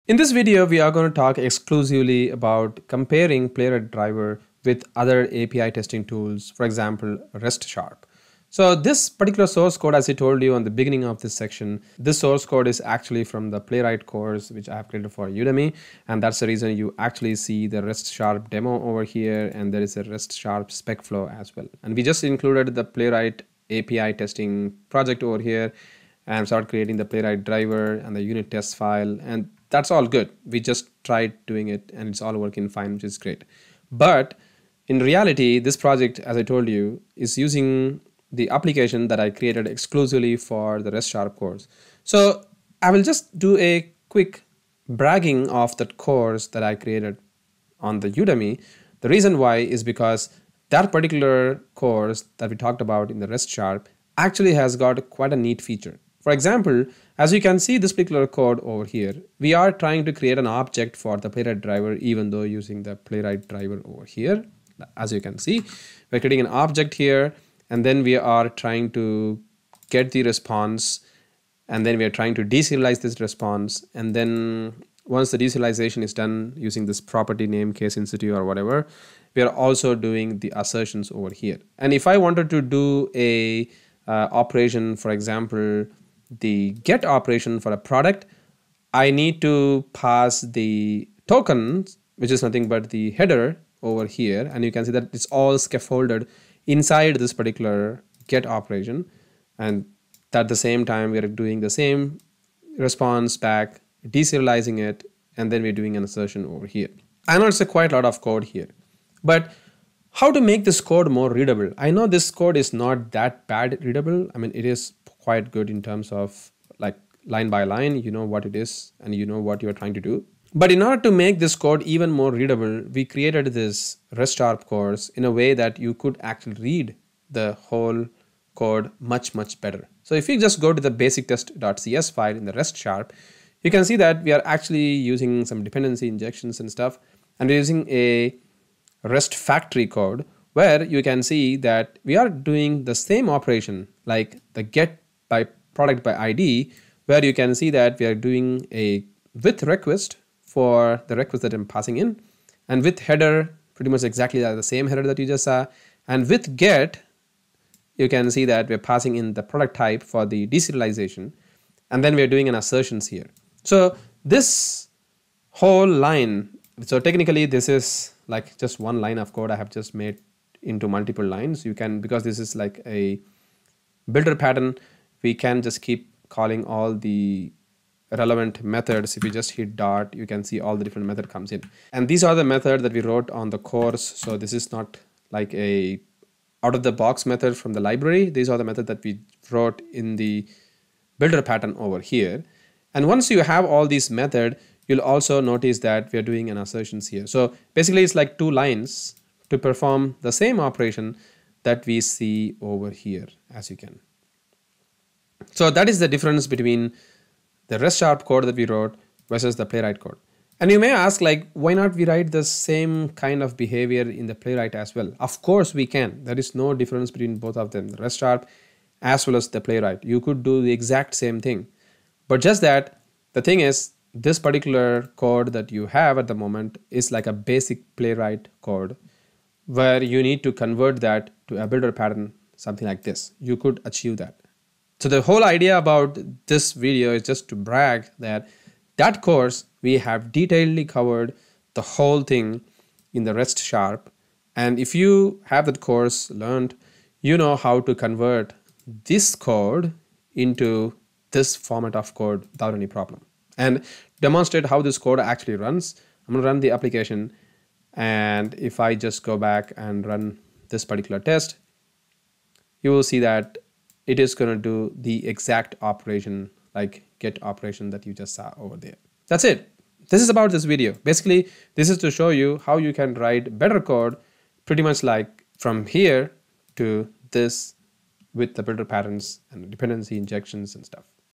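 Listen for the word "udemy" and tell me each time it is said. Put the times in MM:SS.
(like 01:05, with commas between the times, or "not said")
00:15, 00:48.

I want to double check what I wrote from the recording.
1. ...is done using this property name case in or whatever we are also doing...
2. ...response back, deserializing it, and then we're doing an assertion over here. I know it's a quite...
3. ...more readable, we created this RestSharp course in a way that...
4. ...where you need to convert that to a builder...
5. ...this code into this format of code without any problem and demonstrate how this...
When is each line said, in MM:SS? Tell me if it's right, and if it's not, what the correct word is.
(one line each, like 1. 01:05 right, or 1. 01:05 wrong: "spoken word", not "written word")
1. 01:16 right
2. 01:42 right
3. 02:02 right
4. 03:49 right
5. 04:09 right.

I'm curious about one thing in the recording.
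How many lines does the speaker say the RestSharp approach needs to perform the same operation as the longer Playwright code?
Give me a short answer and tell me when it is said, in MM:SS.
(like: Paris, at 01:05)
2, at 03:18.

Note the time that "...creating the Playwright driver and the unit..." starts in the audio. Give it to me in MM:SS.
00:26.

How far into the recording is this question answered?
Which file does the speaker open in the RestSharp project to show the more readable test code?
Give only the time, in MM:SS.
02:10.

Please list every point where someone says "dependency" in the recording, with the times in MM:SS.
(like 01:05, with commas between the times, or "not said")
02:15, 04:39.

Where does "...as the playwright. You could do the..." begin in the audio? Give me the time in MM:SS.
03:39.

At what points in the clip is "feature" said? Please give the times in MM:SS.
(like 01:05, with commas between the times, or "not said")
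00:55.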